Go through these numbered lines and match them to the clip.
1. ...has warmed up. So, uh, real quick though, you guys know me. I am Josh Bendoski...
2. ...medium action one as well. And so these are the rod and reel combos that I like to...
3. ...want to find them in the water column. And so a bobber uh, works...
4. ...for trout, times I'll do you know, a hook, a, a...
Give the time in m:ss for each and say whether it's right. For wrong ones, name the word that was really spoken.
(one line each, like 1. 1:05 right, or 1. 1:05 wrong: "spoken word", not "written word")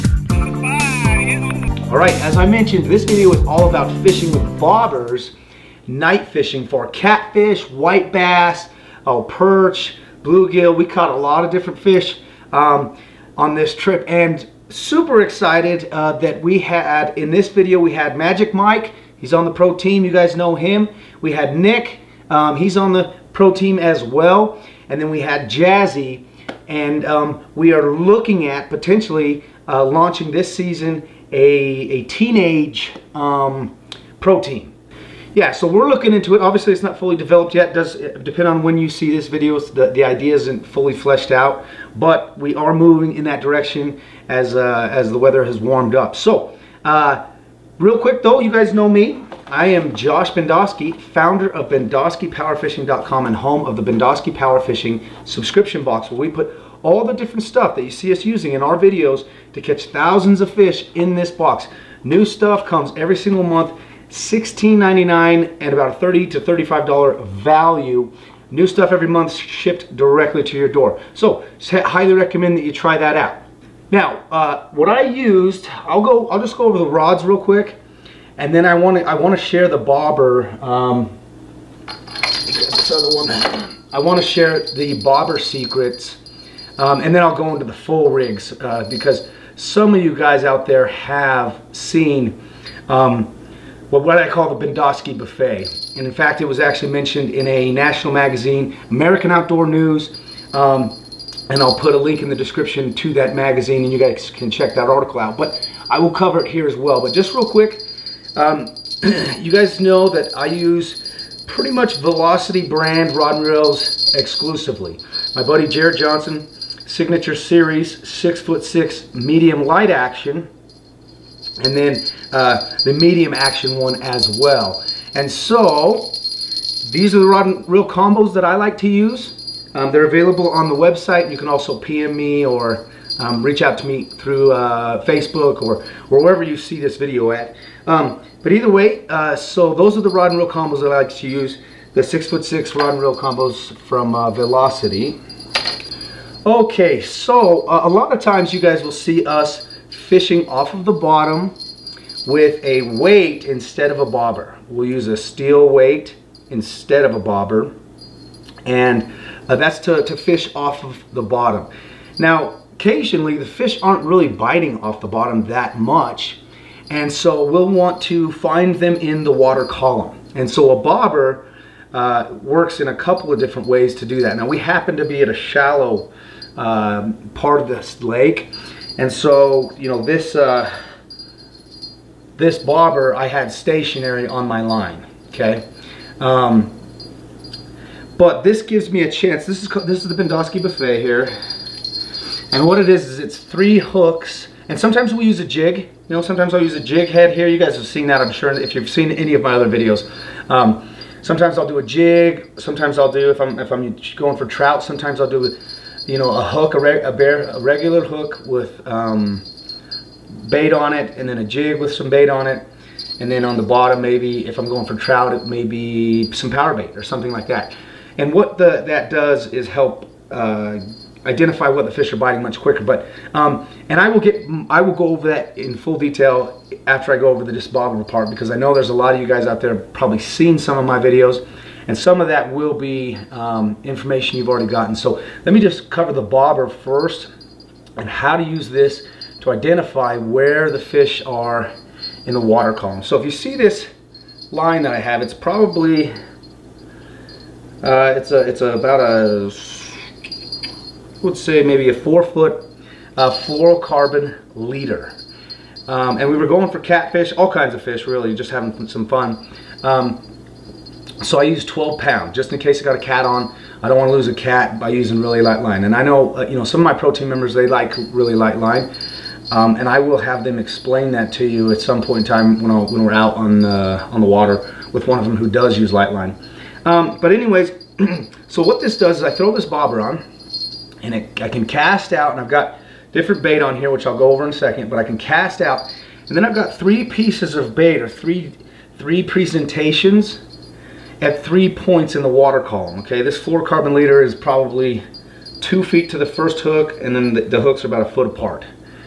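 1. 0:45 right
2. 2:03 right
3. 2:47 right
4. 3:24 wrong: "sometimes", not "times".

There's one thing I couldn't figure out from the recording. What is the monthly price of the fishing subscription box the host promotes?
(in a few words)
$16.99.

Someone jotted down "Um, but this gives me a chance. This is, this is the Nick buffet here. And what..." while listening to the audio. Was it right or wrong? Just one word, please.
wrong.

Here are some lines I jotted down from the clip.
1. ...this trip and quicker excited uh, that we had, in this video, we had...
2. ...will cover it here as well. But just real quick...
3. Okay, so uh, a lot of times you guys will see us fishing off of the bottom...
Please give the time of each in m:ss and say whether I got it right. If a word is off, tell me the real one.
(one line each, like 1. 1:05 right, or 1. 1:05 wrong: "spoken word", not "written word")
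1. 0:13 wrong: "super", not "quicker"
2. 1:45 right
3. 2:26 right.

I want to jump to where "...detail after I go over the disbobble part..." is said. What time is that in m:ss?
3:45.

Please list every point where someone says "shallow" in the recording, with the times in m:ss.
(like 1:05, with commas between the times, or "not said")
2:55.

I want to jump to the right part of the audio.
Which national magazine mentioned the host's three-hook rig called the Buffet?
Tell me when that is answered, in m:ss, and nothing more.
1:38.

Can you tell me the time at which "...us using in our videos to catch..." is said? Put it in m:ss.
0:58.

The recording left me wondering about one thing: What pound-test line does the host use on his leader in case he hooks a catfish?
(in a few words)
12 pound.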